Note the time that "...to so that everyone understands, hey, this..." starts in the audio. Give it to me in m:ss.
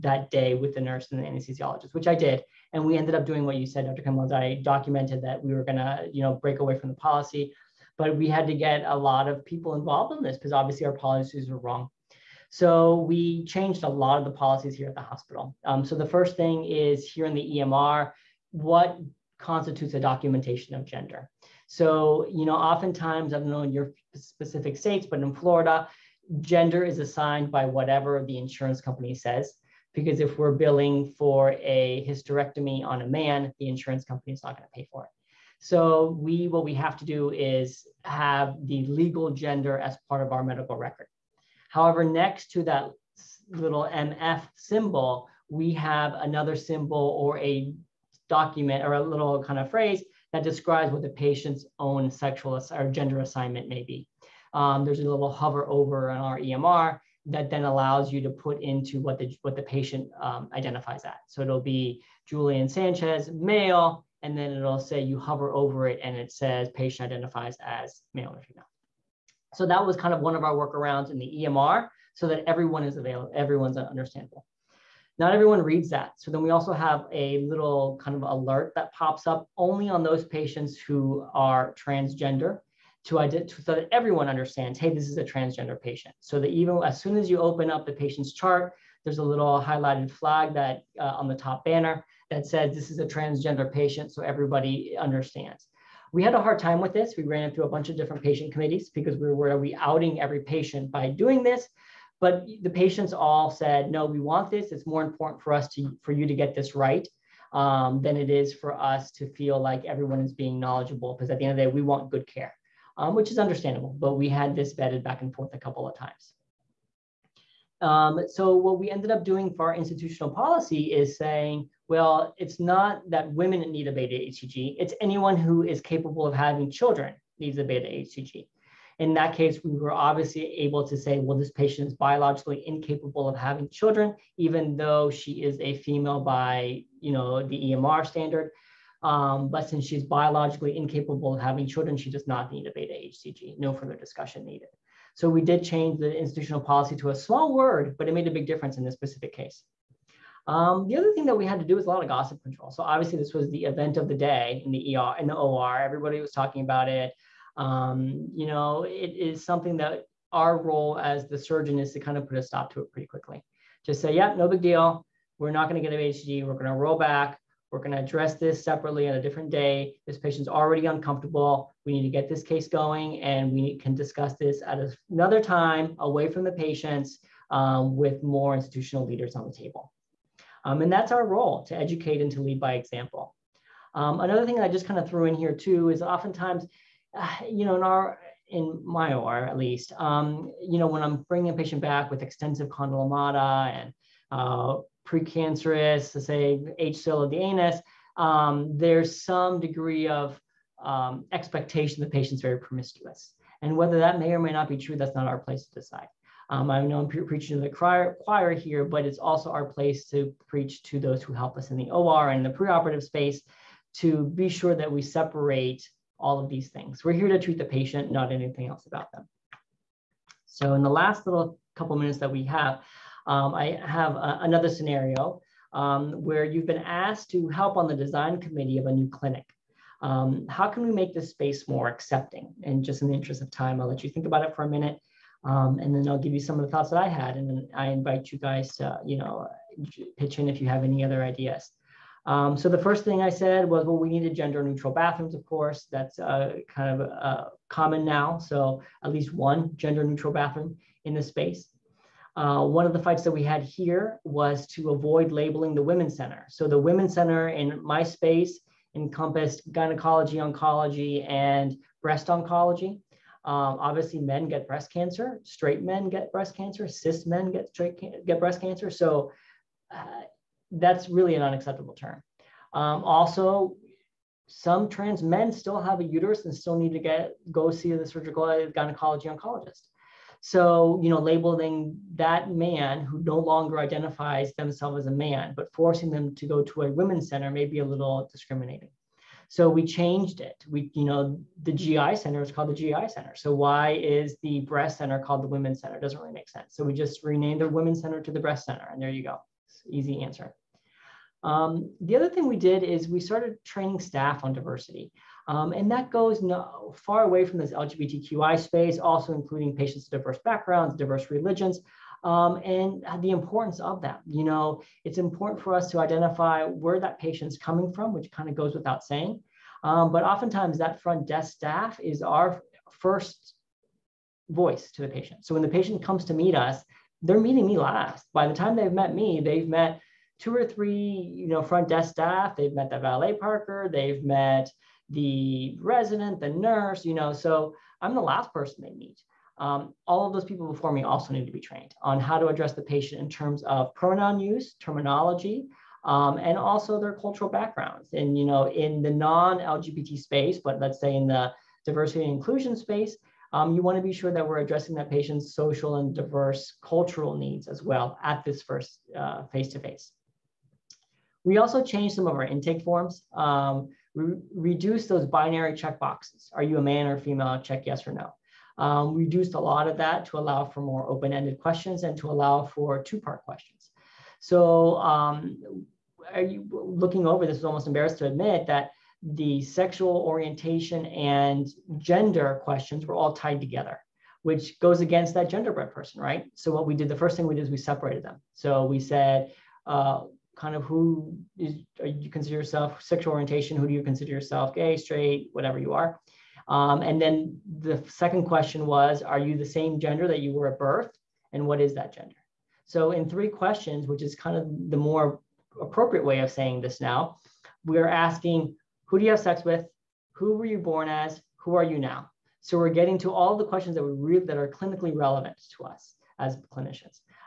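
1:23.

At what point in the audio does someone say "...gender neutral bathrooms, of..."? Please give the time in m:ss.
4:04.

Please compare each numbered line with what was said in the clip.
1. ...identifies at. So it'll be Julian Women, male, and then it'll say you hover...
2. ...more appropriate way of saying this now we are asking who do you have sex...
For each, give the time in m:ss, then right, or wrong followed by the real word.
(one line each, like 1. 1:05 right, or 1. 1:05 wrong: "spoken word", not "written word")
1. 1:00 wrong: "Sanchez", not "Women"
2. 6:44 right.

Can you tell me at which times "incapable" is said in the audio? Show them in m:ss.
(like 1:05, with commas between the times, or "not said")
2:12, 2:20.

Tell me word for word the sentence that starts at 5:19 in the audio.
Um, but oftentimes that front desk staff is our first voice to the patient.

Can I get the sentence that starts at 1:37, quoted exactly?
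We ran through a bunch of different patient committees because we were, we outing every patient by doing this?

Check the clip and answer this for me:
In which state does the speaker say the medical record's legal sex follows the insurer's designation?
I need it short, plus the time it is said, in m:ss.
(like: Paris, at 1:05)
Florida, at 0:25.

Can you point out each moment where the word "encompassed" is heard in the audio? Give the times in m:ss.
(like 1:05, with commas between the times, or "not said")
4:18.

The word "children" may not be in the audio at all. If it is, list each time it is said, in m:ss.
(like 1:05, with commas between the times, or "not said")
2:06, 2:13, 2:21.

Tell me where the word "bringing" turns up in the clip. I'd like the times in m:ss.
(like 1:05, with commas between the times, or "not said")
3:11.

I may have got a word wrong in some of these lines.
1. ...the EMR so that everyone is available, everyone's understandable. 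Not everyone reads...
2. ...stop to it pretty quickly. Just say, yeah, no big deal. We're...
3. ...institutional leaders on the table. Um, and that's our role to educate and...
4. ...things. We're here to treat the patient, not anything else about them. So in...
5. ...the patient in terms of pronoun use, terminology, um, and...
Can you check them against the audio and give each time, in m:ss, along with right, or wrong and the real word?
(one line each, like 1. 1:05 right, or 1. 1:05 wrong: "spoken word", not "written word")
1. 1:11 right
2. 2:42 right
3. 2:58 right
4. 3:36 right
5. 5:42 right.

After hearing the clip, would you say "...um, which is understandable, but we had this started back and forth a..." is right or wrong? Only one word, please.
wrong.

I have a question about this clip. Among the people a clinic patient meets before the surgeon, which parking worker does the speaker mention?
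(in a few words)
valet parker.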